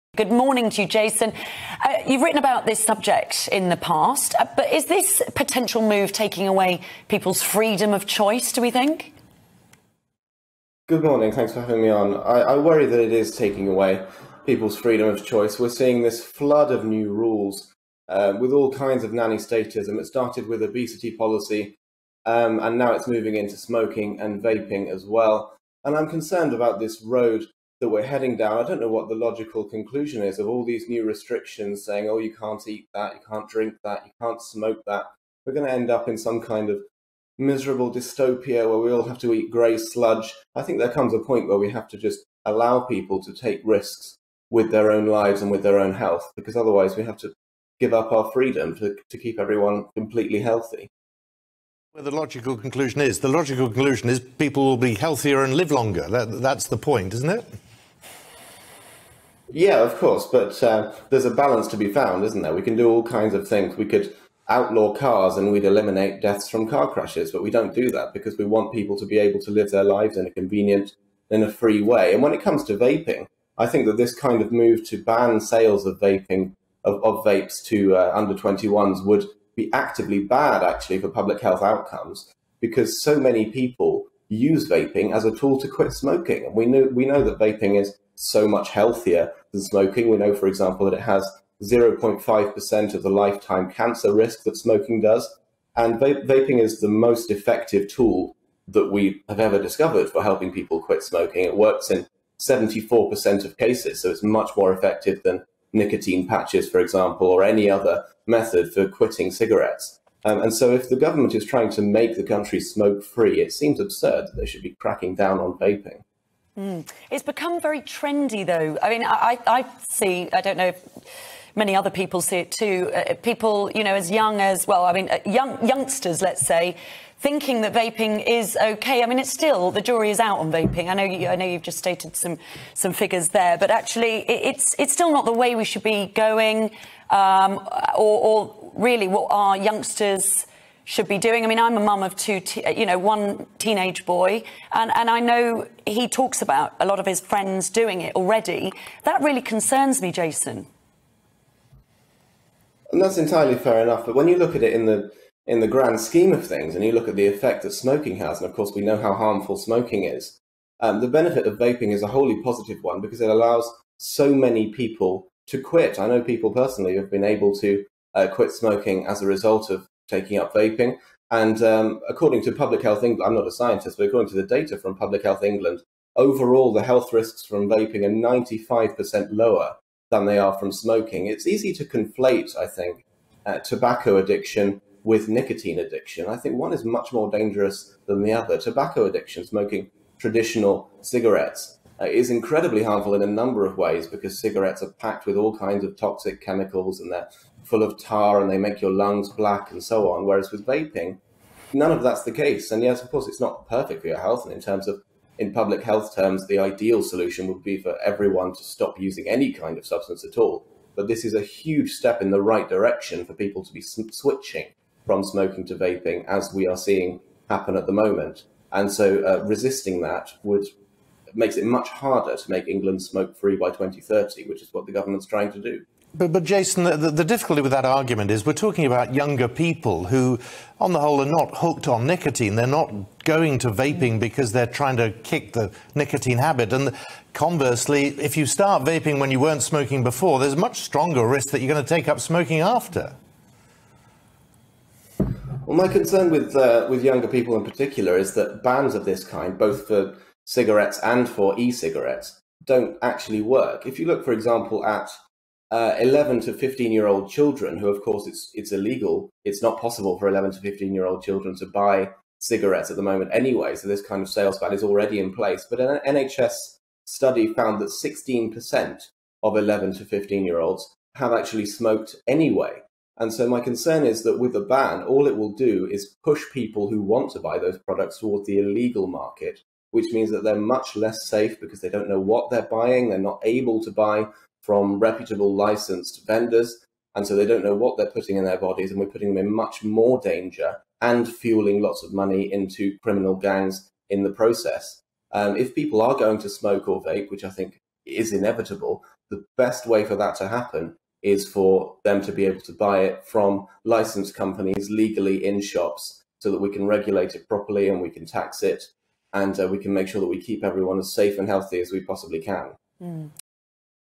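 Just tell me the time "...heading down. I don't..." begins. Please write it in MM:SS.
00:28.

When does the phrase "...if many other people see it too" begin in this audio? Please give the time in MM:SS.
02:00.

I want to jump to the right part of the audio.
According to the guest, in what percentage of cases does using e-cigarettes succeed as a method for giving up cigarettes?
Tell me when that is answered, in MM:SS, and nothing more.
01:42.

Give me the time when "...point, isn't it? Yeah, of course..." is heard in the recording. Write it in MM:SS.
00:56.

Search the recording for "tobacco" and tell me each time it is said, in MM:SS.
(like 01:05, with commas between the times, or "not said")
03:03, 03:08.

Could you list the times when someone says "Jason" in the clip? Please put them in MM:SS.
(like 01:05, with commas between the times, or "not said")
00:00, 02:30, 03:46.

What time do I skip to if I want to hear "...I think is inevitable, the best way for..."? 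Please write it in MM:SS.
04:57.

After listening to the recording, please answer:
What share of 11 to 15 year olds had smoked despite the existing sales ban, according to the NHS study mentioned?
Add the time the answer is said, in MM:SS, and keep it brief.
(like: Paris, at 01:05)
16%, at 04:27.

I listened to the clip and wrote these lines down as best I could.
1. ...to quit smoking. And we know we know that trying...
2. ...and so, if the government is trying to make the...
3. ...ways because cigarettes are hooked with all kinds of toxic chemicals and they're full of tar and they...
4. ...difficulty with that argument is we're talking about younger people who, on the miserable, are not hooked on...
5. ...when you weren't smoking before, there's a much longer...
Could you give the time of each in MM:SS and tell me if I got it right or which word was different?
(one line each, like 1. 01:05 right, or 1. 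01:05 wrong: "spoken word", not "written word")
1. 01:25 wrong: "vaping", not "trying"
2. 01:50 right
3. 03:13 wrong: "packed", not "hooked"
4. 03:47 wrong: "whole", not "miserable"
5. 03:59 wrong: "stronger", not "longer".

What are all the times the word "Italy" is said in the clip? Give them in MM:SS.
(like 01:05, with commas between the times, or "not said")
not said.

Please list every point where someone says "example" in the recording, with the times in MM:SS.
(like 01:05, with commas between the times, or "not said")
01:30, 01:46, 04:14.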